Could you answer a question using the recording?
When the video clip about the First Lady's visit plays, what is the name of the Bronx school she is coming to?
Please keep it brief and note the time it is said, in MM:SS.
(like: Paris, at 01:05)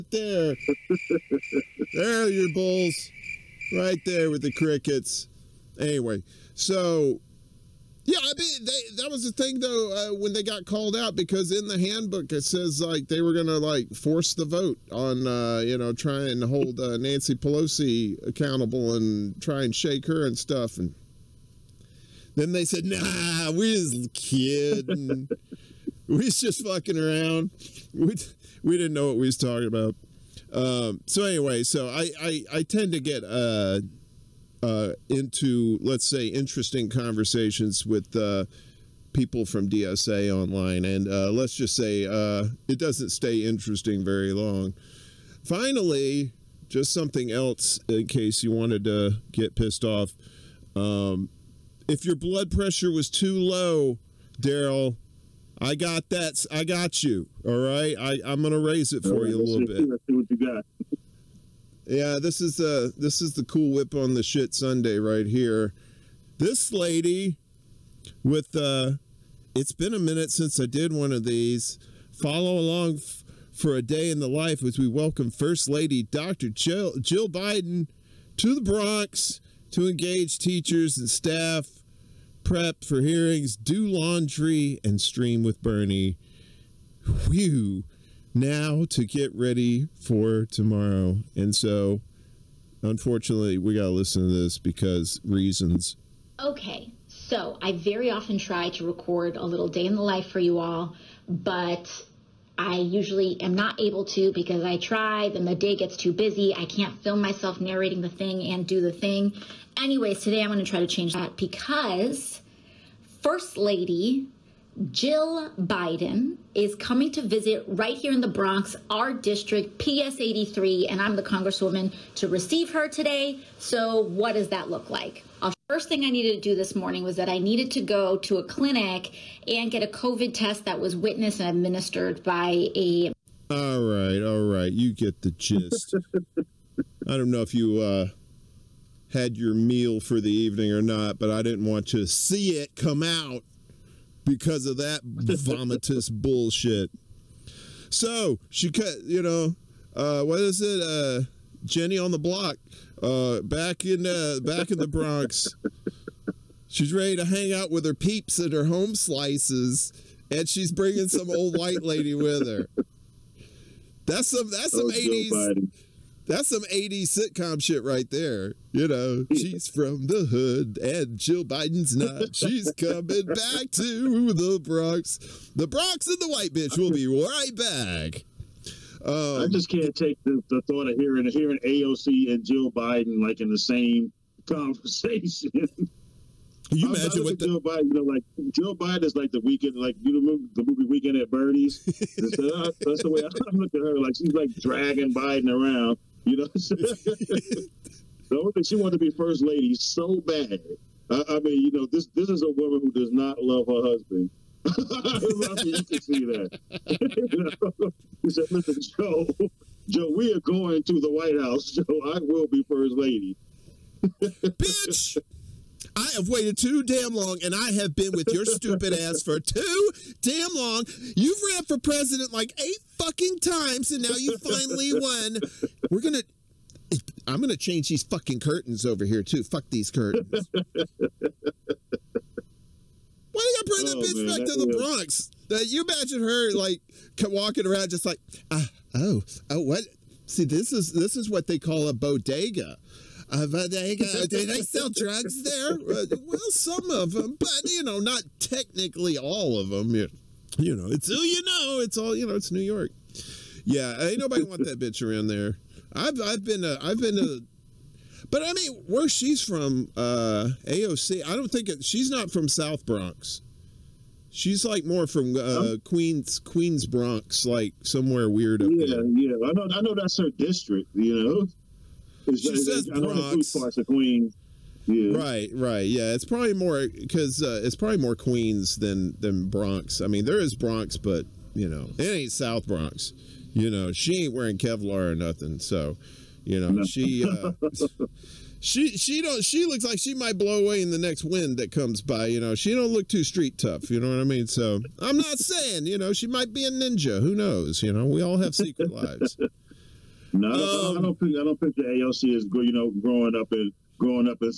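PS 83, at 01:59.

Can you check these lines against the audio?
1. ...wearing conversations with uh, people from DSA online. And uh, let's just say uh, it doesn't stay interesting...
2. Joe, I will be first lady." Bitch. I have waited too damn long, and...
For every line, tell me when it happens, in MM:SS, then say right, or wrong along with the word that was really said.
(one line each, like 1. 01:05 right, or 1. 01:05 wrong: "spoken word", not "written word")
1. 00:36 wrong: "interesting", not "wearing"
2. 03:31 right.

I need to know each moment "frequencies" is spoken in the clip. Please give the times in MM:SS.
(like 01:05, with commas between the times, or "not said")
not said.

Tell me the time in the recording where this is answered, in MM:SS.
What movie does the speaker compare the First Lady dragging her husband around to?
03:10.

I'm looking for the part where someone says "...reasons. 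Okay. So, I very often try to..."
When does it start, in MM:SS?
01:35.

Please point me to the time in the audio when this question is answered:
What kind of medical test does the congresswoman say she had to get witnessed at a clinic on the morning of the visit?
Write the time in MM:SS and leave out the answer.
02:09.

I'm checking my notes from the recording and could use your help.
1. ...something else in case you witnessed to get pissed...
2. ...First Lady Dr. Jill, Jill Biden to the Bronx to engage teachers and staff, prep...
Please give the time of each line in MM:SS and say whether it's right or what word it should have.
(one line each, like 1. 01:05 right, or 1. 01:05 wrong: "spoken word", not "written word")
1. 00:46 wrong: "wanted", not "witnessed"
2. 01:15 right.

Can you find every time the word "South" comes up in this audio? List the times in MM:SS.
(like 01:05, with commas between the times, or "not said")
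04:22, 04:42.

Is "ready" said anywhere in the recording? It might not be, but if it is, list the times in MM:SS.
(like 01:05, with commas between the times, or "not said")
01:29, 02:36.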